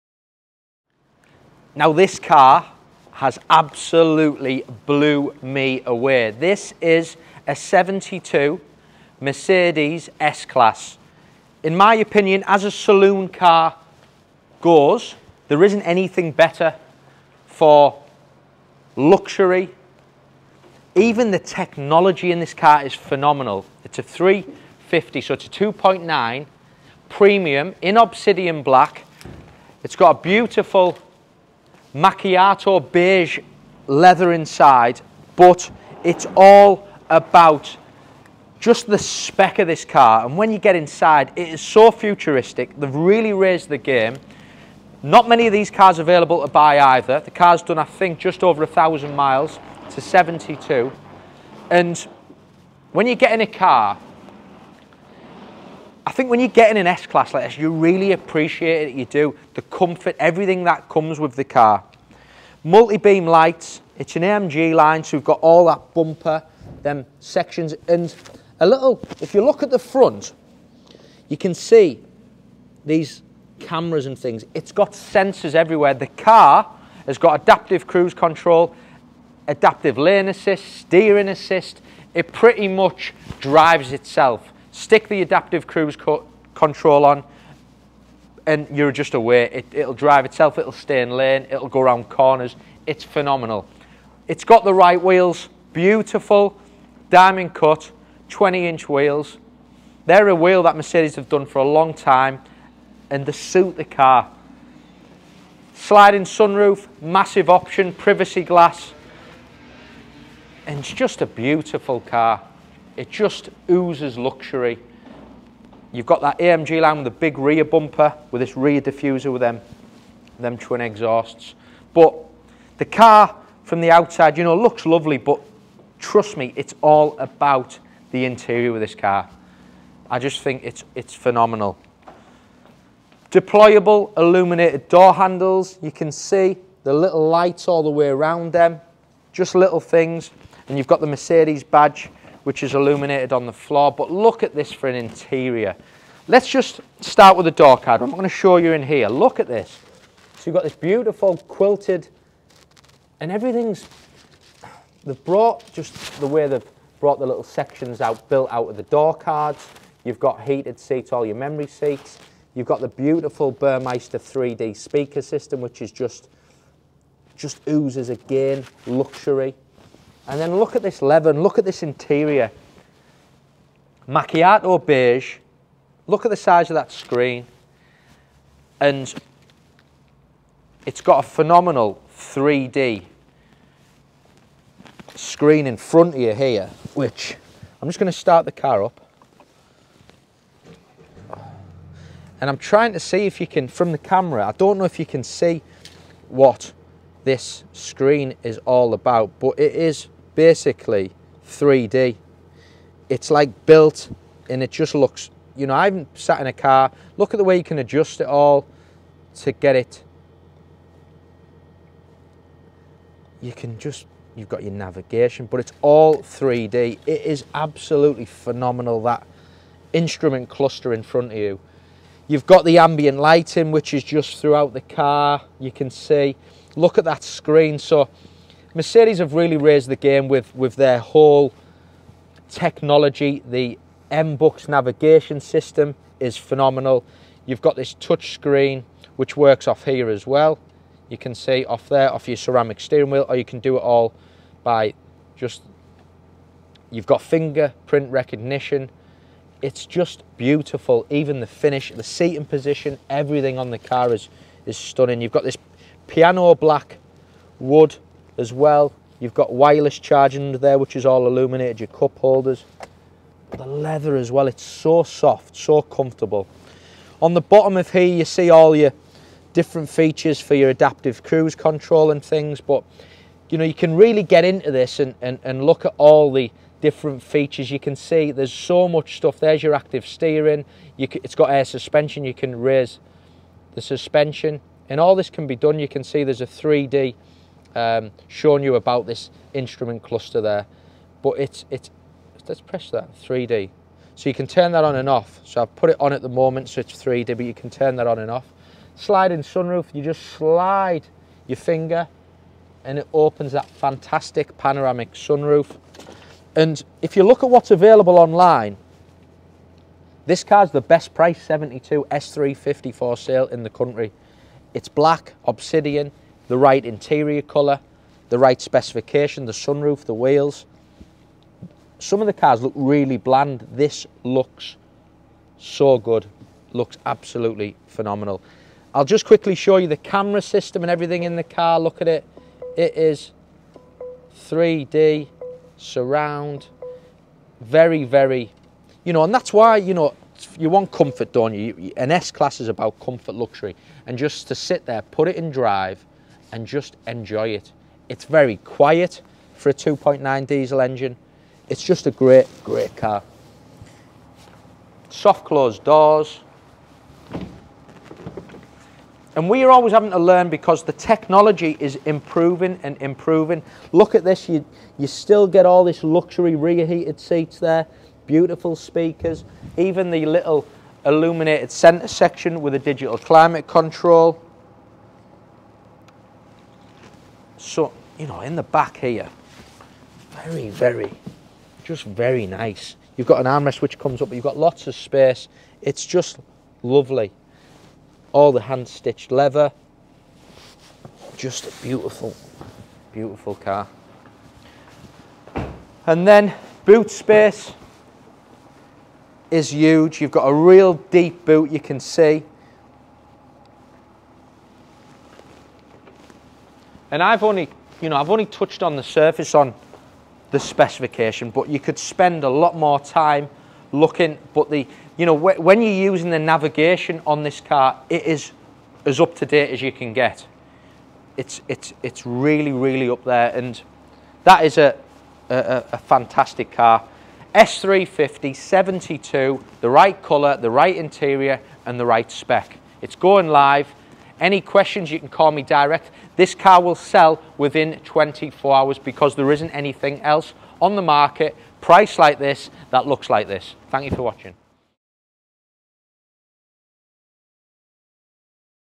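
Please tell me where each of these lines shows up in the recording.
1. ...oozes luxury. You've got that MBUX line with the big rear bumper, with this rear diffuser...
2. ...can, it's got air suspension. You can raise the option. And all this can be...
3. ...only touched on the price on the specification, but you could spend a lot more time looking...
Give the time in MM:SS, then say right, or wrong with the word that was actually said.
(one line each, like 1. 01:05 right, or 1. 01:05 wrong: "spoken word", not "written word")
1. 01:53 wrong: "AMG", not "MBUX"
2. 04:41 wrong: "suspension", not "option"
3. 06:48 wrong: "surface", not "price".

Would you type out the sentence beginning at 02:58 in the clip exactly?
And it's got a phenomenal 3D screen in front of you here, which I'm just going to start the car up.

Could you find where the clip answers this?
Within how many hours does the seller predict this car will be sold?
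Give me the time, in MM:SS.
07:17.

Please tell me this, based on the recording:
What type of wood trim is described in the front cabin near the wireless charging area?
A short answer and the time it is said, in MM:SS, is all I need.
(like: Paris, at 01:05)
Piano black wood, at 04:16.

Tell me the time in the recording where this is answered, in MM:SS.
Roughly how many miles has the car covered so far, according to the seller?
00:48.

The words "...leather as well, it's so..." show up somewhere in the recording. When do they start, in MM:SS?
04:23.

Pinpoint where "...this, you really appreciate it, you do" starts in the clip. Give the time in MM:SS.
00:57.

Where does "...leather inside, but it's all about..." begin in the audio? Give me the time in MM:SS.
00:33.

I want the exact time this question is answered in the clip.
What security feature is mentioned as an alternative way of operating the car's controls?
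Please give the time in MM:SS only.
04:07.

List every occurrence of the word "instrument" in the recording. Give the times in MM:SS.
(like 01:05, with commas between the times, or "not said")
03:39, 04:49.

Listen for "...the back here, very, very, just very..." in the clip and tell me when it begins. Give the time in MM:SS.
06:18.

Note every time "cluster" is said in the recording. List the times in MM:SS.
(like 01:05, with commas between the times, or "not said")
03:40, 04:50.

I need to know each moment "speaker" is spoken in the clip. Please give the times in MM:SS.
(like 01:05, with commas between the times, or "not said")
02:44, 06:08.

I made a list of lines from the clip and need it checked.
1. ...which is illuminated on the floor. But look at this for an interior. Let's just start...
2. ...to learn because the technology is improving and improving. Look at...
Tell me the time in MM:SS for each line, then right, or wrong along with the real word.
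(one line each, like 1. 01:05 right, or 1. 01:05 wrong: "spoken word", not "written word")
1. 02:22 right
2. 06:00 right.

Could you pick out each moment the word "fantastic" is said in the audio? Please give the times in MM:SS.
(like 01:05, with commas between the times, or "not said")
05:03, 07:05.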